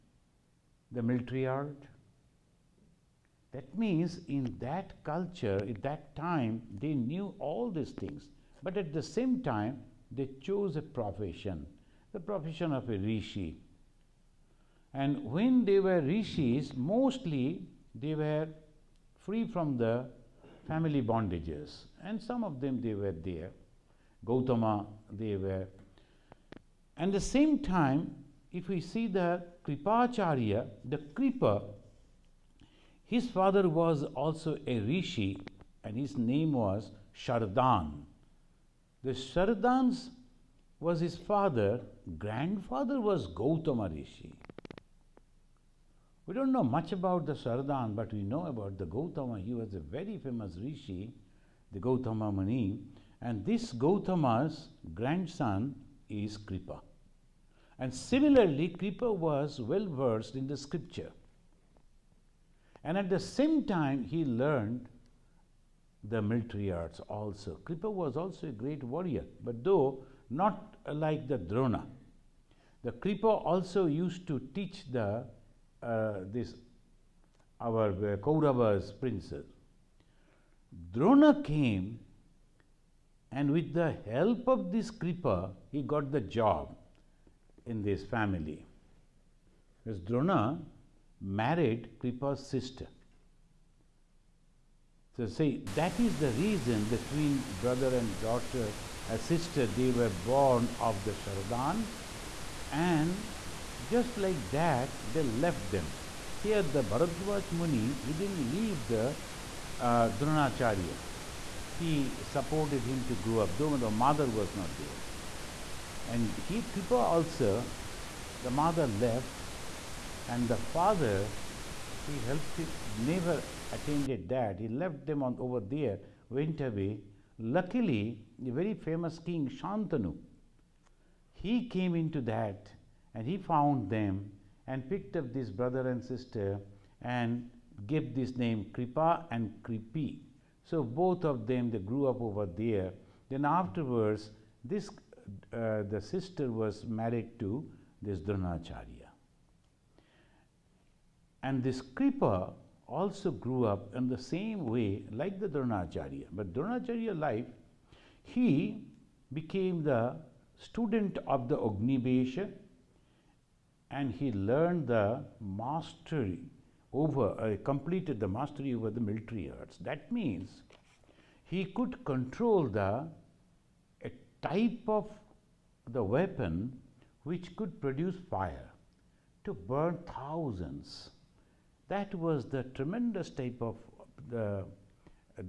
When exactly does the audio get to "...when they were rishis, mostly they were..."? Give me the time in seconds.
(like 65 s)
15 s.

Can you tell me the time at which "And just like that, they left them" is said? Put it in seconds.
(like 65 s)
102 s.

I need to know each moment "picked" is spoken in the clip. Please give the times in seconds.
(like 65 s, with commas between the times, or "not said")
134 s.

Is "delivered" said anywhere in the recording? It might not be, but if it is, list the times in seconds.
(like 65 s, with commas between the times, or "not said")
not said.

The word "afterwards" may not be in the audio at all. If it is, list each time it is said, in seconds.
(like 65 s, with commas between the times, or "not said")
143 s.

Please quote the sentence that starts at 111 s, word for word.
He supported him to grow up, though the mother was not there.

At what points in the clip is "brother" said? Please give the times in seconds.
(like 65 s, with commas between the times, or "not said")
97 s, 135 s.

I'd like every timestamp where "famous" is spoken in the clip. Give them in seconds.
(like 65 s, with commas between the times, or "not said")
50 s, 128 s.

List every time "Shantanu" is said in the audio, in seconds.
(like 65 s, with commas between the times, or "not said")
129 s.